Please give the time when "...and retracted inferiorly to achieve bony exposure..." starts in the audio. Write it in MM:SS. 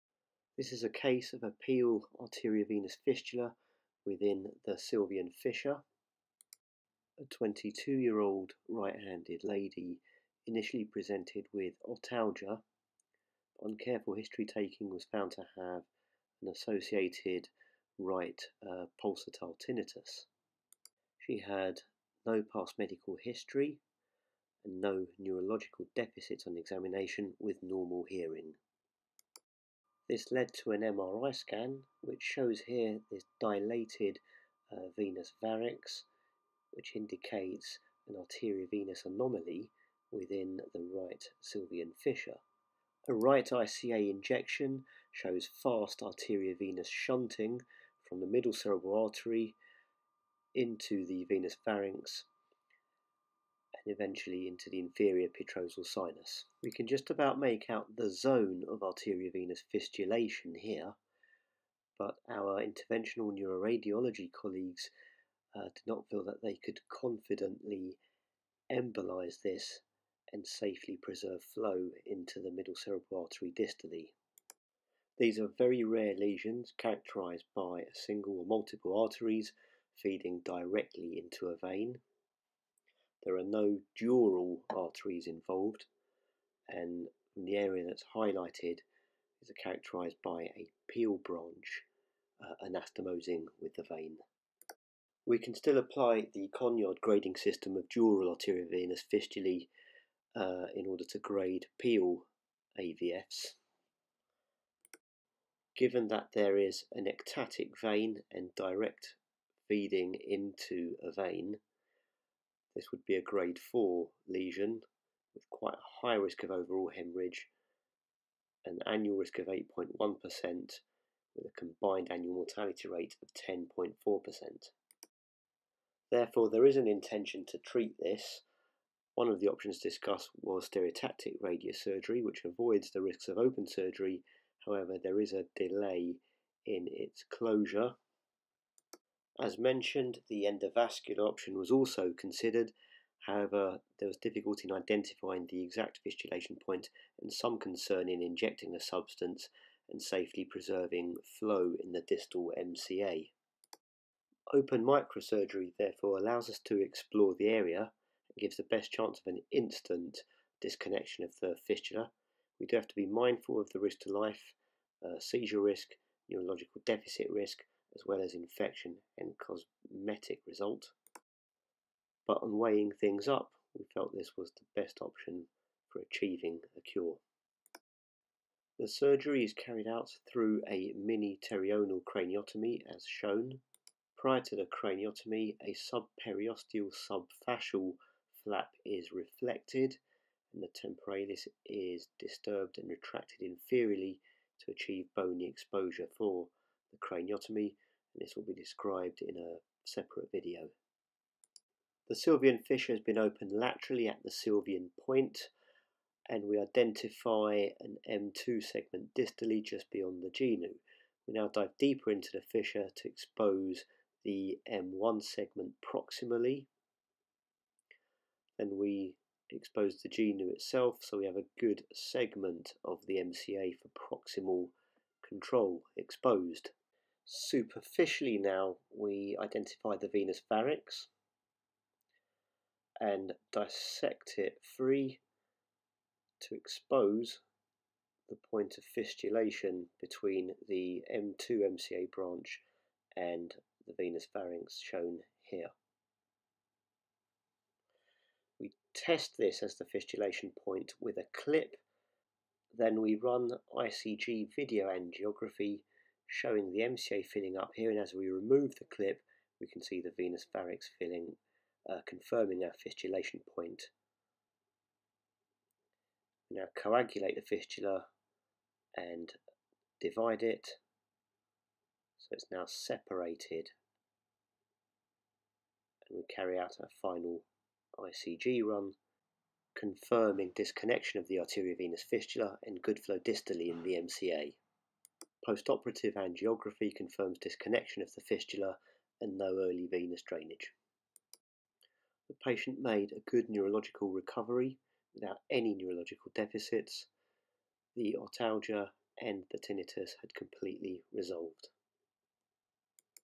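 03:12.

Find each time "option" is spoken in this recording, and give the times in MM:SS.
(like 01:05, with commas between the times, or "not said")
02:09, 02:21, 02:55.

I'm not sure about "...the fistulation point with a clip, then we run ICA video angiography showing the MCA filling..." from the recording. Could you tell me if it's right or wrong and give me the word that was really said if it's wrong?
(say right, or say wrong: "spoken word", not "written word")
wrong: "ICG", not "ICA".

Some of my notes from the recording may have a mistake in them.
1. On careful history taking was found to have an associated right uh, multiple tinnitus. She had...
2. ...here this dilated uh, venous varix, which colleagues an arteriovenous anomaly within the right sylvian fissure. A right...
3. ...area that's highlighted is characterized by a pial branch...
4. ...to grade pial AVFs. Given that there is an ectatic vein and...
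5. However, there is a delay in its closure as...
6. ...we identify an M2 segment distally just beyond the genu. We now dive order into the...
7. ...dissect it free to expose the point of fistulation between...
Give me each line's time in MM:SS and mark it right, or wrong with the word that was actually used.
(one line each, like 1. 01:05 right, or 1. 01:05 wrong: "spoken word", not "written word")
1. 00:13 wrong: "pulsatile", not "multiple"
2. 00:32 wrong: "indicates", not "colleagues"
3. 01:27 right
4. 01:41 right
5. 02:14 right
6. 03:26 wrong: "deeper", not "order"
7. 03:53 right.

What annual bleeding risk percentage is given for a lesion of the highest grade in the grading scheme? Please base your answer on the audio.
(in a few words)
8.1%.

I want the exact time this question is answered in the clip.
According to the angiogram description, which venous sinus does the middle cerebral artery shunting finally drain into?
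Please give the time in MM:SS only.
00:54.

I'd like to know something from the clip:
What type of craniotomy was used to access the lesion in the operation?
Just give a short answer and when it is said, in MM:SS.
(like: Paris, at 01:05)
Mini pterional, at 03:00.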